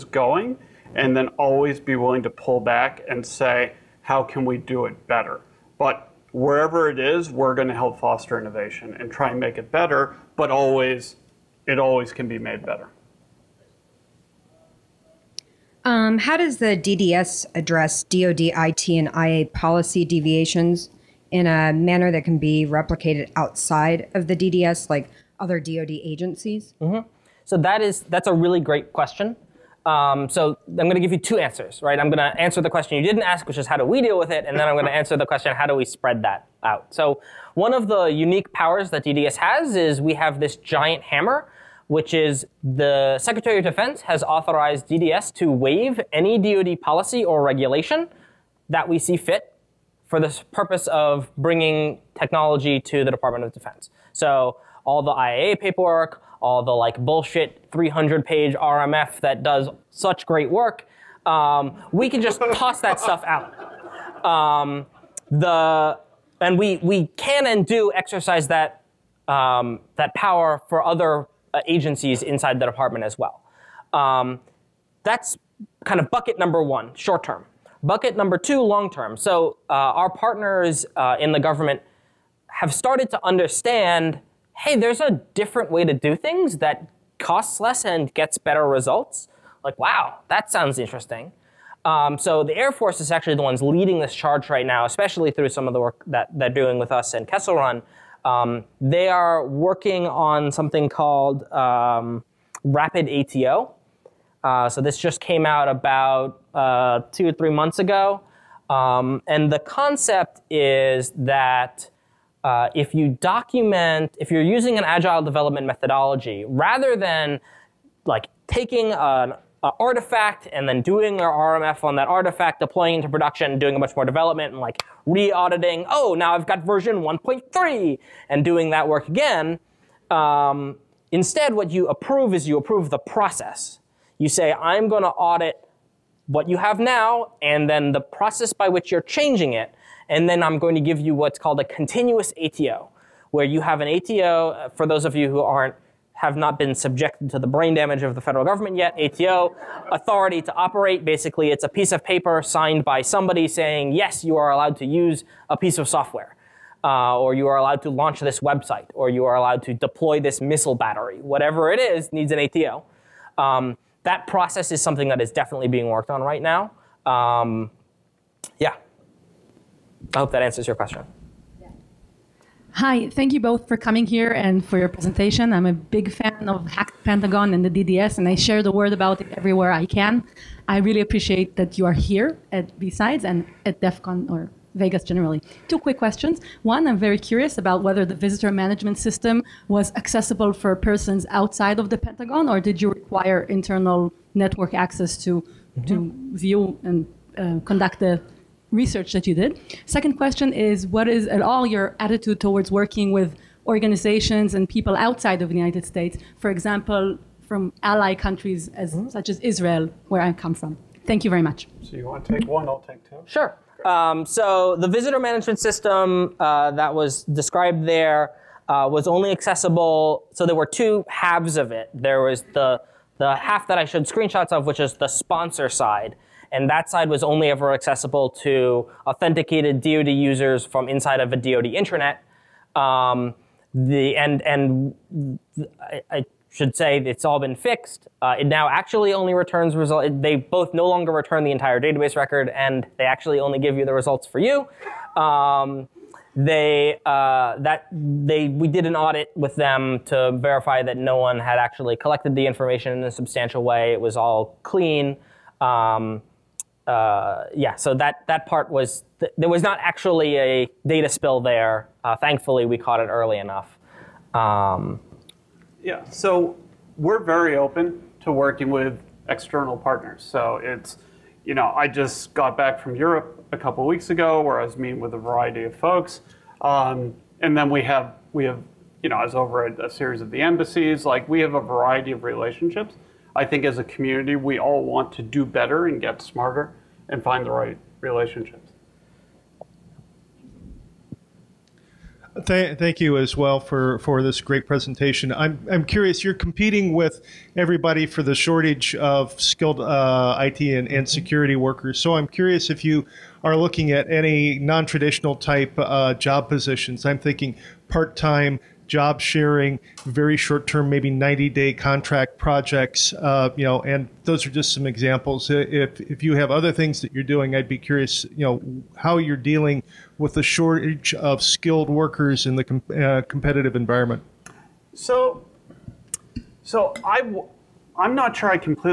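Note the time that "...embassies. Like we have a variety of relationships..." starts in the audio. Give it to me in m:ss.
4:40.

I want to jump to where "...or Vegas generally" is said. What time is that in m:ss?
3:04.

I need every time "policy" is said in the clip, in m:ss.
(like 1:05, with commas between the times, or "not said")
0:19, 0:46.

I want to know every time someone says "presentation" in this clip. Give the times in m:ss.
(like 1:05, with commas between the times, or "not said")
2:54, 4:54.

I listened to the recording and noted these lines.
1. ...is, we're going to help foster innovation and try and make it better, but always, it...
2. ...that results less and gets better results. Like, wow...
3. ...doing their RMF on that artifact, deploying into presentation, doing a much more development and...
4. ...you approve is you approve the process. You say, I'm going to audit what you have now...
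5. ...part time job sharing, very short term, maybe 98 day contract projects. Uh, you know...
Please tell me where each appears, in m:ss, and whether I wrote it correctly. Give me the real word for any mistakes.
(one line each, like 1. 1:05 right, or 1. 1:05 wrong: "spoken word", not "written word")
1. 0:06 right
2. 1:26 wrong: "costs", not "results"
3. 2:00 wrong: "production", not "presentation"
4. 2:11 right
5. 5:07 wrong: "90", not "98".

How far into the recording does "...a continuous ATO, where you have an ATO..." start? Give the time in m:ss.
2:21.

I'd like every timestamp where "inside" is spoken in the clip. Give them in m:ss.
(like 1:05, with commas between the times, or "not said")
1:12, 3:50.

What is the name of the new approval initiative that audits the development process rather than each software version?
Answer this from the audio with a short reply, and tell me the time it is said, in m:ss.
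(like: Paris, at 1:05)
Rapid ATO, at 1:42.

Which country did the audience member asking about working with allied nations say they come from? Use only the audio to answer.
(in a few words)
Israel.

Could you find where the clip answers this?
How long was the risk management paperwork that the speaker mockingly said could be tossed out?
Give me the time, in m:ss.
0:57.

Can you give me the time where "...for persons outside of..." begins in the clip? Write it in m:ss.
3:10.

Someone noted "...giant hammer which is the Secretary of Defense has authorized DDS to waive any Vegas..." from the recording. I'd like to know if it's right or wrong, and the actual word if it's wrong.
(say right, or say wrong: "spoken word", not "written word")
wrong: "DoD", not "Vegas".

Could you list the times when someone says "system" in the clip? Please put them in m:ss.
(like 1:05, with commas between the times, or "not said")
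3:08, 3:35.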